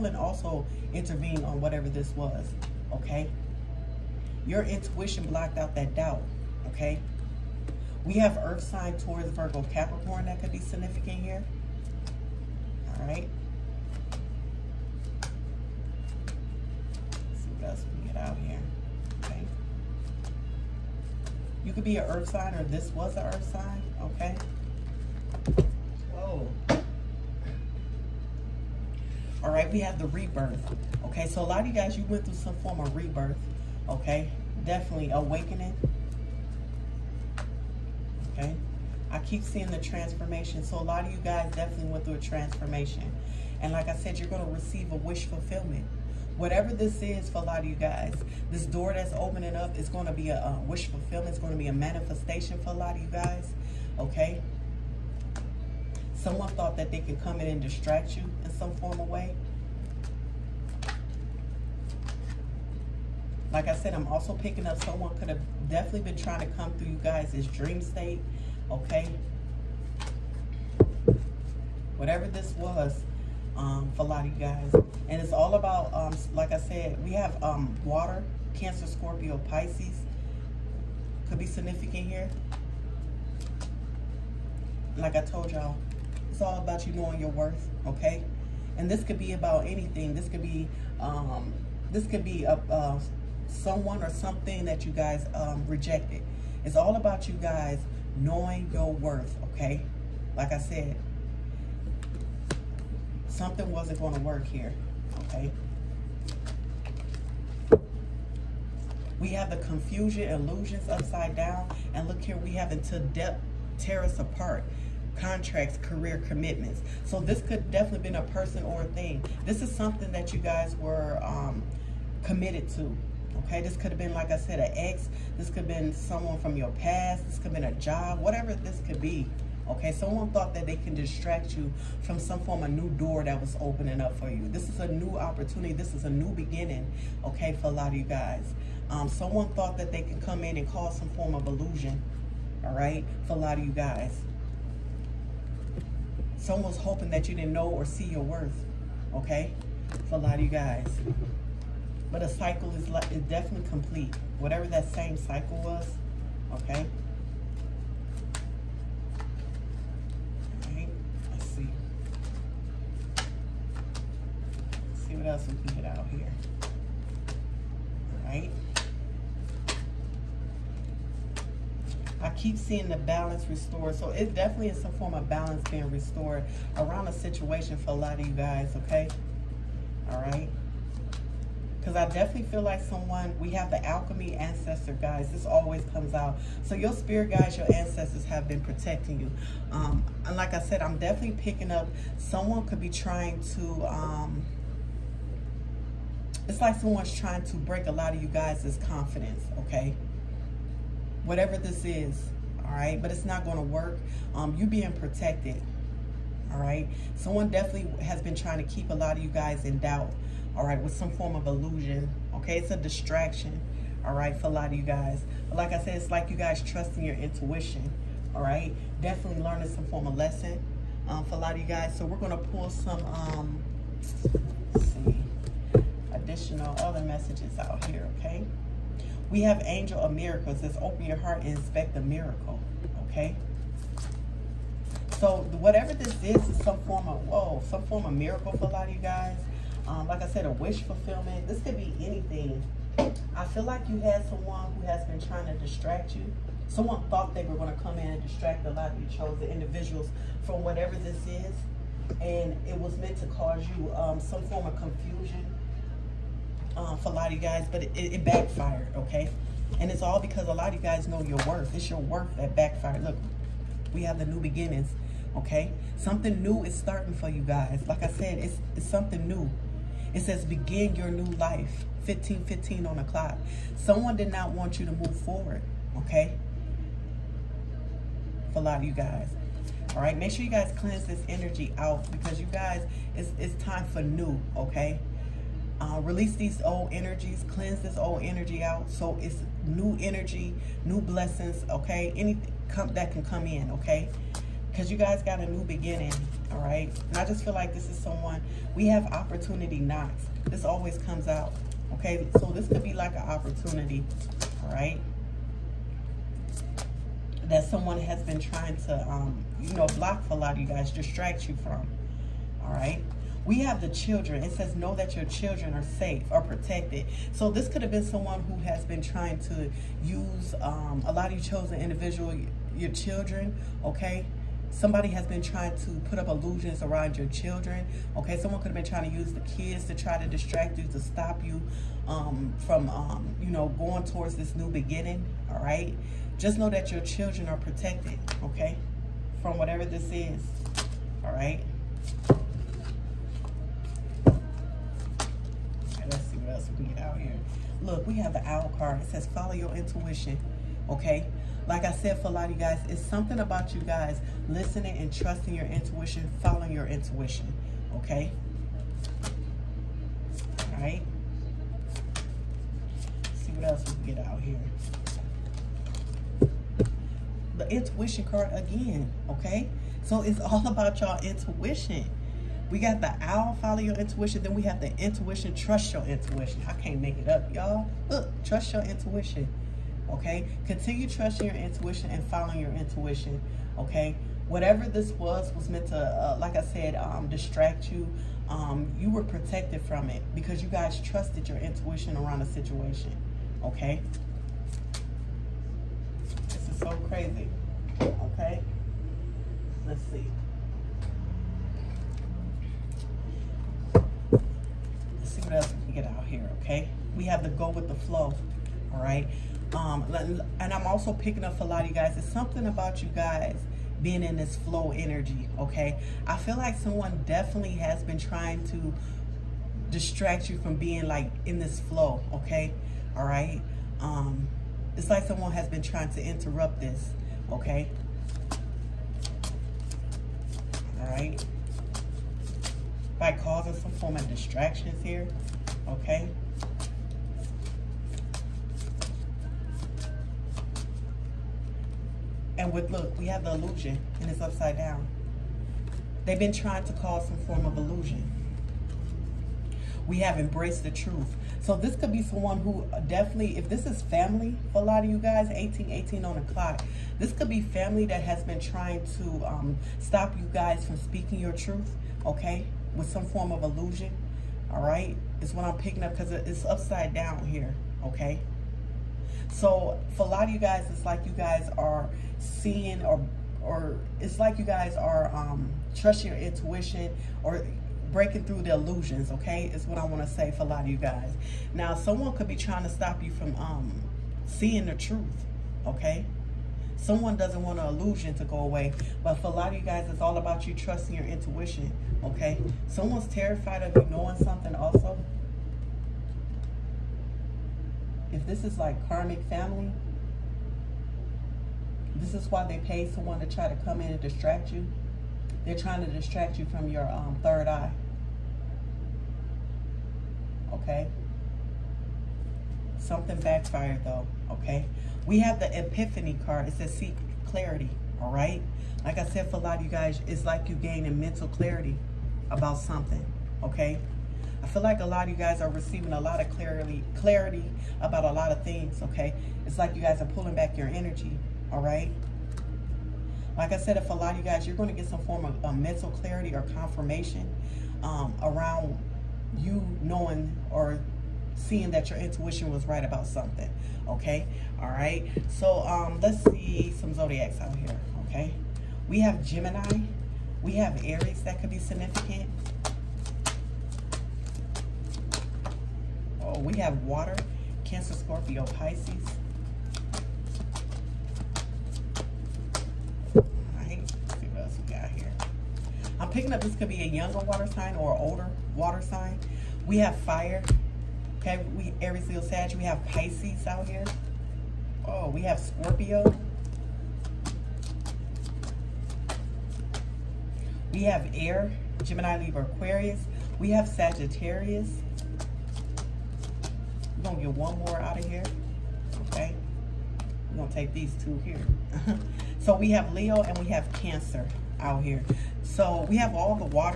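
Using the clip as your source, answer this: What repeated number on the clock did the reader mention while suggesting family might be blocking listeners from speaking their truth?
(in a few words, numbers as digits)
18.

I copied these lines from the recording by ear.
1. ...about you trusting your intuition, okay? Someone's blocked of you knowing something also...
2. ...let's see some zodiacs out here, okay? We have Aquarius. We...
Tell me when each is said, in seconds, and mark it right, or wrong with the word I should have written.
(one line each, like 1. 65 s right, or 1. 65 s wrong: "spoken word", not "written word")
1. 490 s wrong: "terrified", not "blocked"
2. 546 s wrong: "Gemini", not "Aquarius".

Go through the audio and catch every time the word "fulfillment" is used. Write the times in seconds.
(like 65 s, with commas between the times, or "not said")
45 s, 50 s, 240 s.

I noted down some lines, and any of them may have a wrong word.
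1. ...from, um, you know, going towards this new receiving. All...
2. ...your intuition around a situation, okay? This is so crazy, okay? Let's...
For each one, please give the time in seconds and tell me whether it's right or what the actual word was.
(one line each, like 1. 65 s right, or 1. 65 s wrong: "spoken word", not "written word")
1. 332 s wrong: "beginning", not "receiving"
2. 391 s right.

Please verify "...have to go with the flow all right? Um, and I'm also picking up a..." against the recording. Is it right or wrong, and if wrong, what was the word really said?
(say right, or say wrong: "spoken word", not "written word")
right.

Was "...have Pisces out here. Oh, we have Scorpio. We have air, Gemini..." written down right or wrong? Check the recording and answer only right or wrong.
right.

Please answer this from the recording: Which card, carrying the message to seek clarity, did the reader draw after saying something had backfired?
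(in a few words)
Epiphany.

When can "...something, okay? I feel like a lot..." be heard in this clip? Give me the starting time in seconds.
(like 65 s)
522 s.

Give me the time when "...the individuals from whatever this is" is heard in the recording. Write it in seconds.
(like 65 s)
249 s.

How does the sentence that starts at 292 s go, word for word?
Anything come, that can come in, okay?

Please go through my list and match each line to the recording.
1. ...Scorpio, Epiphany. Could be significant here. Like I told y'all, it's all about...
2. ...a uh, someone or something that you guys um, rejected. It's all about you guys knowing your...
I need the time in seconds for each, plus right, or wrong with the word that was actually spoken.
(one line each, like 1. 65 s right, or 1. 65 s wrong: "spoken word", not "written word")
1. 78 s wrong: "Pisces", not "Epiphany"
2. 92 s right.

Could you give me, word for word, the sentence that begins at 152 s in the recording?
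But a cycle is, is definitely complete.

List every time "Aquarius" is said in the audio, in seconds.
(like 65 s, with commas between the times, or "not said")
582 s.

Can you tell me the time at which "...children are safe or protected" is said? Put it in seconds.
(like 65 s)
315 s.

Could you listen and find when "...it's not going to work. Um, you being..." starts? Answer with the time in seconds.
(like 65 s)
203 s.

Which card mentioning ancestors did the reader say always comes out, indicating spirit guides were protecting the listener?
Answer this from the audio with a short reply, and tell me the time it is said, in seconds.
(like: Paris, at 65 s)
Alchemy ancestor, at 183 s.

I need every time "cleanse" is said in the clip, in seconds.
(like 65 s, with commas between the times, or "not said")
280 s, 287 s.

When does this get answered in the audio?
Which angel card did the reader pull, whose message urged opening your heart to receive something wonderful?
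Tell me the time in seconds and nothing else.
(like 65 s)
229 s.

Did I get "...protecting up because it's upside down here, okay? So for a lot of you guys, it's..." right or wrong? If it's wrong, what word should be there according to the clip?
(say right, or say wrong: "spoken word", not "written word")
wrong: "picking", not "protecting".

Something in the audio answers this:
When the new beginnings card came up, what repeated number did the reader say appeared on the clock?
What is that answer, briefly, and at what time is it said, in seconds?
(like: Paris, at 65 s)
15, at 272 s.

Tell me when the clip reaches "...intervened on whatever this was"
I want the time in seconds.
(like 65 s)
0 s.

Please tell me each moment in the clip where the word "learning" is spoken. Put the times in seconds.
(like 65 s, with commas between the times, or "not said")
219 s.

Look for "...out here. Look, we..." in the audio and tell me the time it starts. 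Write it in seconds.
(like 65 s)
347 s.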